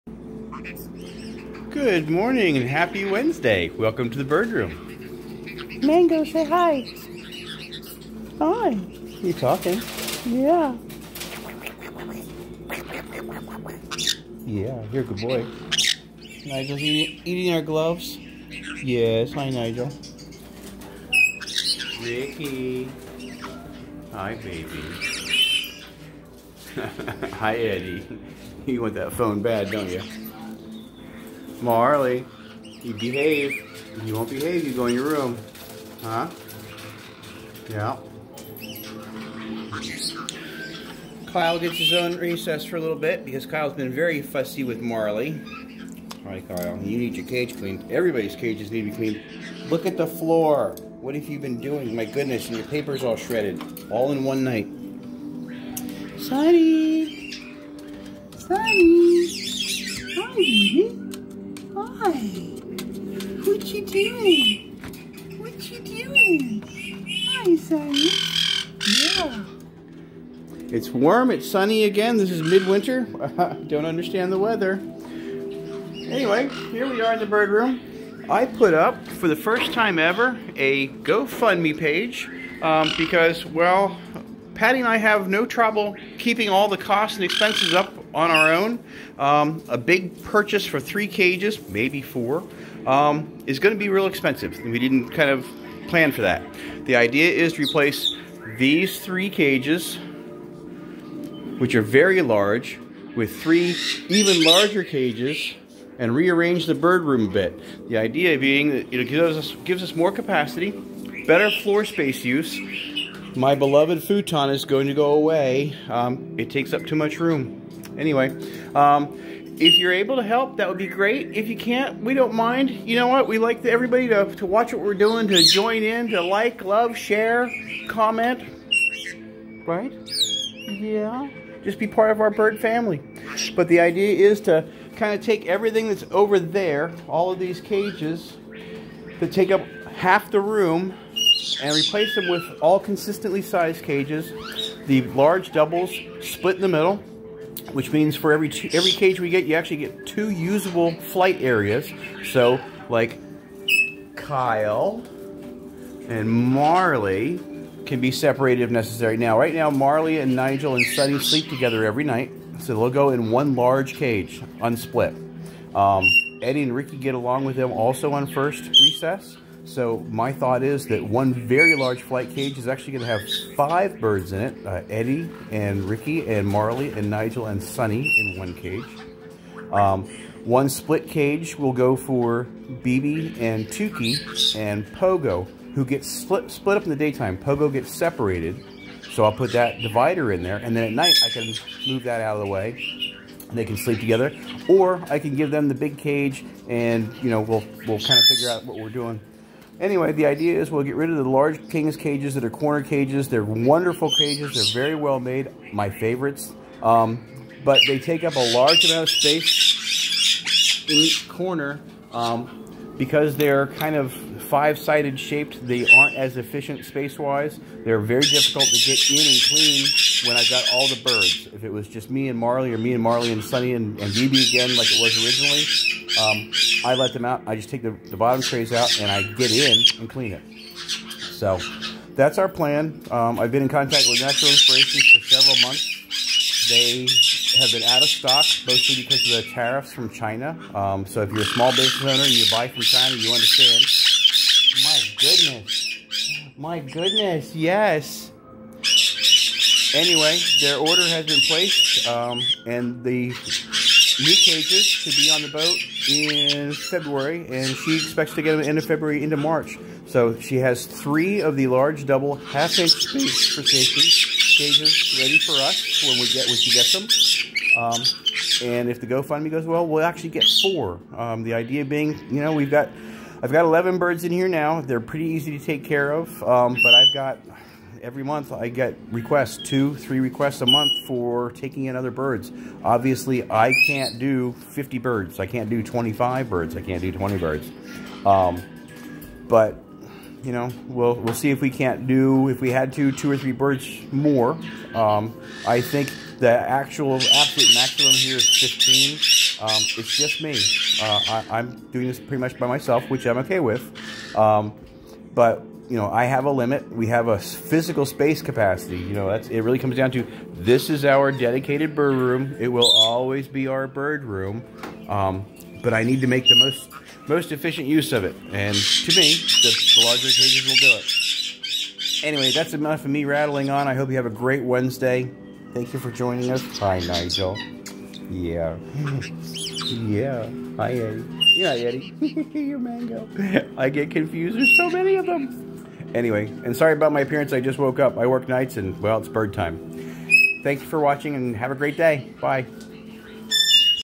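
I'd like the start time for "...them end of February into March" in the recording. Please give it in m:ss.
4:18.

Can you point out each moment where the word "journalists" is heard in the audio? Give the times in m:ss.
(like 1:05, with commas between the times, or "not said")
not said.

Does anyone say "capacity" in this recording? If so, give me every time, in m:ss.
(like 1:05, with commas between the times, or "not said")
1:50, 5:08.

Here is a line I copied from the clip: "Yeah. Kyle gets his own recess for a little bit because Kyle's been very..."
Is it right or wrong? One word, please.
right.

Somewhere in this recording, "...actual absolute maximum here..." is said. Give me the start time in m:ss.
4:56.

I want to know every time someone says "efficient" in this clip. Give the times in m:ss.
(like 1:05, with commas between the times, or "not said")
3:36, 5:17.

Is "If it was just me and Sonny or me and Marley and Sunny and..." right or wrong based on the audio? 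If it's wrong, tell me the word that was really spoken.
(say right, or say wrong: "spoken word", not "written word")
wrong: "Marley", not "Sonny".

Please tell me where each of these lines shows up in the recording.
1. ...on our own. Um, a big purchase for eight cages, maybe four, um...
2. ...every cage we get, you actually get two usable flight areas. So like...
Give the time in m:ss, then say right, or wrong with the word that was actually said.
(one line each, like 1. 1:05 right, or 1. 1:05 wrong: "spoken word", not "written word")
1. 1:28 wrong: "three", not "eight"
2. 2:28 right.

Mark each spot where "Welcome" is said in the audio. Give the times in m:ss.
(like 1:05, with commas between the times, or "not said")
0:03.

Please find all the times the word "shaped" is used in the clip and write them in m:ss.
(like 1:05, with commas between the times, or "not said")
3:35.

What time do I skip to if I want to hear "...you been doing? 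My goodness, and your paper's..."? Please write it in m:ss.
0:51.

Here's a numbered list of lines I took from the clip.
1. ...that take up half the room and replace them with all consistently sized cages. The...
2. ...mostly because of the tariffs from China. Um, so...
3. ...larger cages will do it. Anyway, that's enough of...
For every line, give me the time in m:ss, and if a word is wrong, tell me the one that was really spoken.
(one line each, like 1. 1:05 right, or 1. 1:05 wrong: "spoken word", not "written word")
1. 2:19 right
2. 3:58 right
3. 5:20 right.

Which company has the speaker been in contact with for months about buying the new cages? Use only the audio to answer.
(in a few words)
Natural Inspirations.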